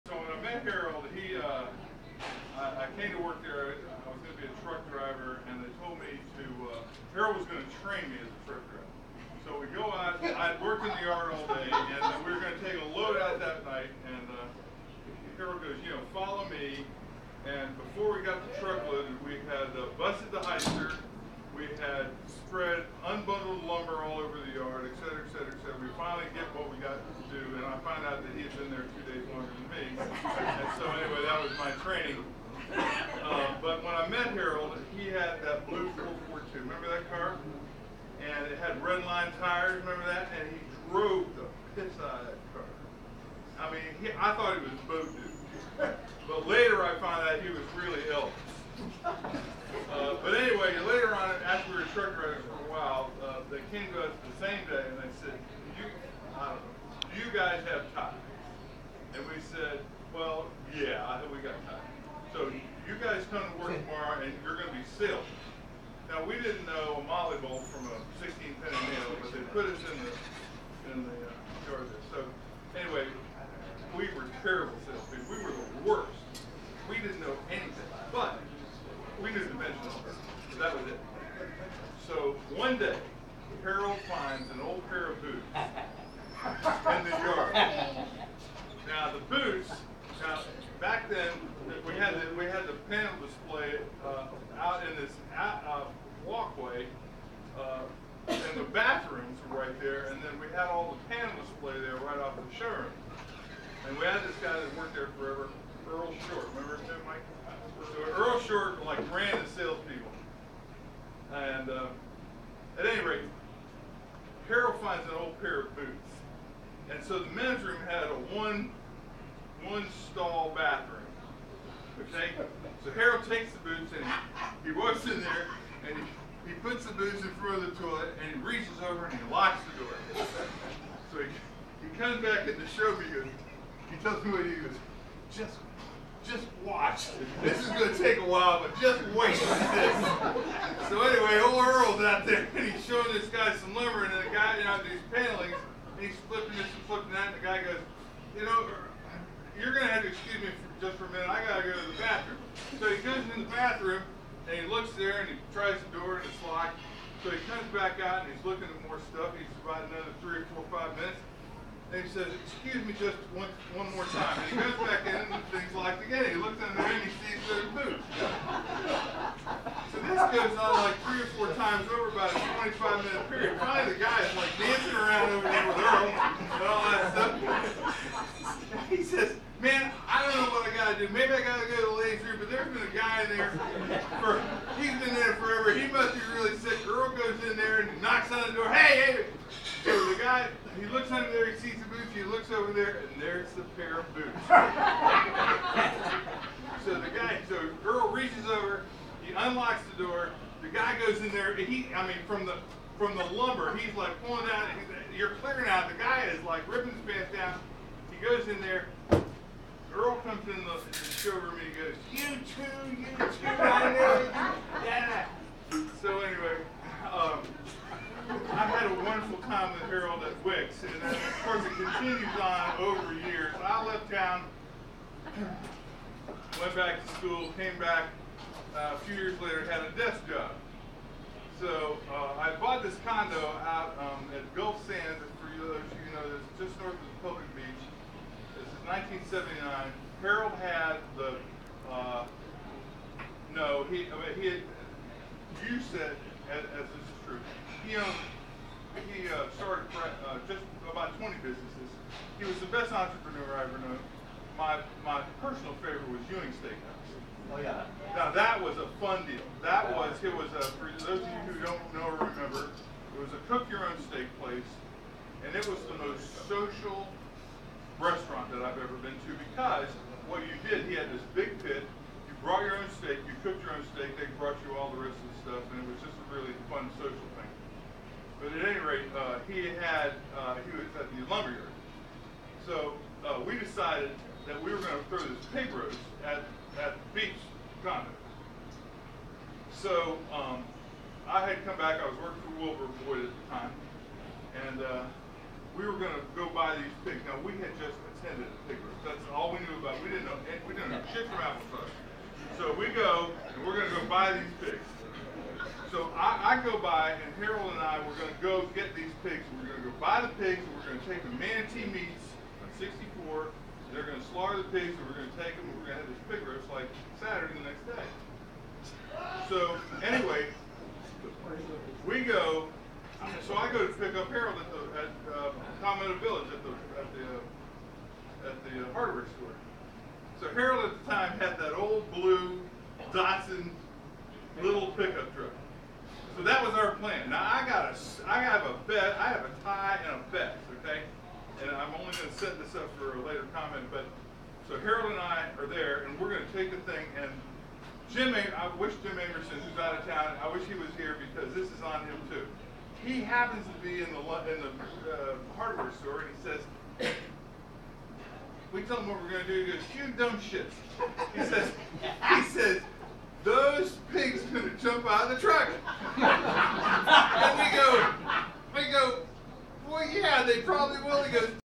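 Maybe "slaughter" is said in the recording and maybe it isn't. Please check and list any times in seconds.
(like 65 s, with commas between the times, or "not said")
314 s.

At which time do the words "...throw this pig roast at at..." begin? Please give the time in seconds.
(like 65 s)
285 s.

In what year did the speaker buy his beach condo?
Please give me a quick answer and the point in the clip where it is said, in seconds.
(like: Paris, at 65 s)
1979, at 239 s.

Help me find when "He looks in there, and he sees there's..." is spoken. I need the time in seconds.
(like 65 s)
166 s.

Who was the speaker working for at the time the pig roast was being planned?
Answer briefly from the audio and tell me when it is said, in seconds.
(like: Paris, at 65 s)
Wilbur Boyd, at 292 s.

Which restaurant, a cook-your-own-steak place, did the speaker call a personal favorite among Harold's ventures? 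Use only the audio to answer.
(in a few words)
Ewing Steakhouse.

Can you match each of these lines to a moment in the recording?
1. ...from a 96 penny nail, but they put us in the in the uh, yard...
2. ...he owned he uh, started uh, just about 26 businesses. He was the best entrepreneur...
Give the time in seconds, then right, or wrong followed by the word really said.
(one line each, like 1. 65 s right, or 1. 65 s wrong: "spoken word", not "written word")
1. 67 s wrong: "16", not "96"
2. 247 s wrong: "20", not "26".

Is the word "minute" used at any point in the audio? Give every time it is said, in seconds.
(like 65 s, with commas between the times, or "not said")
151 s, 160 s, 173 s.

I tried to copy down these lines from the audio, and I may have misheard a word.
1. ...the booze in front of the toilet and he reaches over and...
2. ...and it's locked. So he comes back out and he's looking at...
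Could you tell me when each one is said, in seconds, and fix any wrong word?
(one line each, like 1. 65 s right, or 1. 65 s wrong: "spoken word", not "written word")
1. 126 s right
2. 156 s right.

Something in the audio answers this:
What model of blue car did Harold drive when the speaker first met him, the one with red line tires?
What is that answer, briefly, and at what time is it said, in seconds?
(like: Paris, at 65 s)
442, at 36 s.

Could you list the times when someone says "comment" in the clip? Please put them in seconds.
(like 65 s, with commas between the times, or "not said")
343 s.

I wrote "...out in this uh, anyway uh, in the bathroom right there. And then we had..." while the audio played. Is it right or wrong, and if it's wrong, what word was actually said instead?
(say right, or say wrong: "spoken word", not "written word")
wrong: "walkway", not "anyway".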